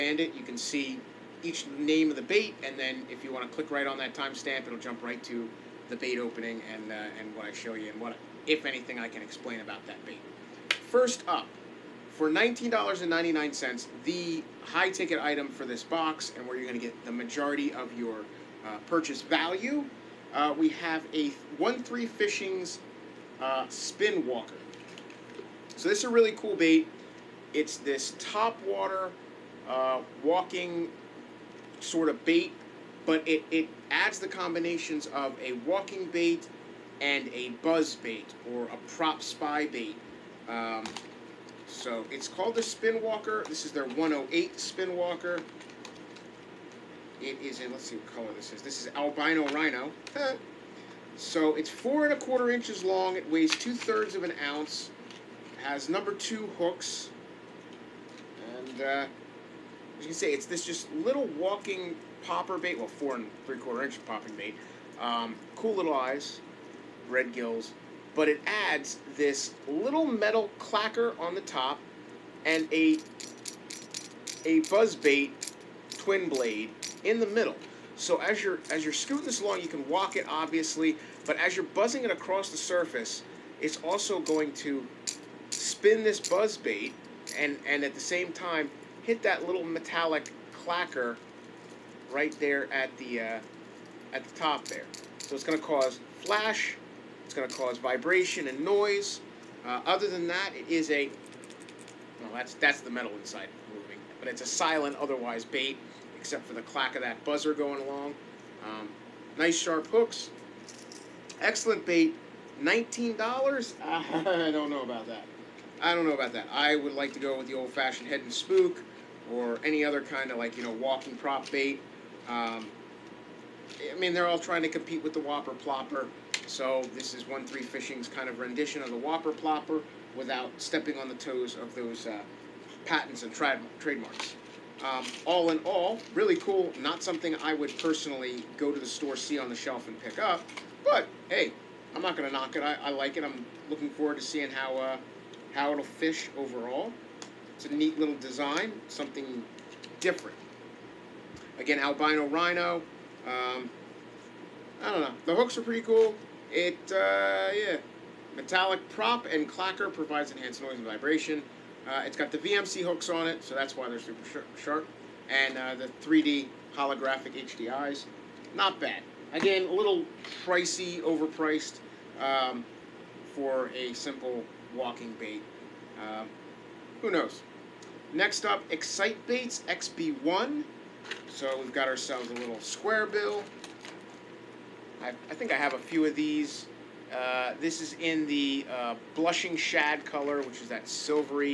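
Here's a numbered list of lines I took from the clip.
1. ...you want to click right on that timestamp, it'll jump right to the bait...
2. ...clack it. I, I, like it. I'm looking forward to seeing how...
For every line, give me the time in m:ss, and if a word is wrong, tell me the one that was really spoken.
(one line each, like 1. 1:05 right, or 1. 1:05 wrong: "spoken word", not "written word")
1. 0:03 right
2. 2:22 wrong: "knock", not "clack".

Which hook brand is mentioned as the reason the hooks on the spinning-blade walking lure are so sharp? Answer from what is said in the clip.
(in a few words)
VMC.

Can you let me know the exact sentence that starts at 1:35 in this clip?
So it's going to cause flash, it's going to cause vibration and noise.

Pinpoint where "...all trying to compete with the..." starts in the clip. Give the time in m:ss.
2:04.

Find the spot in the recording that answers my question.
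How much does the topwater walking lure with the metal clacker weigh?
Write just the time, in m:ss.
0:53.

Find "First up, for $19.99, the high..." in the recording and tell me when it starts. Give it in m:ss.
0:10.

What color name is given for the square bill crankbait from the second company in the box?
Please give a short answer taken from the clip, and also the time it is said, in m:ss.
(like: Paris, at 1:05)
blushing shad, at 3:09.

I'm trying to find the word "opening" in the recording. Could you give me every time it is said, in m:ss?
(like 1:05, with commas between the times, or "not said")
0:06.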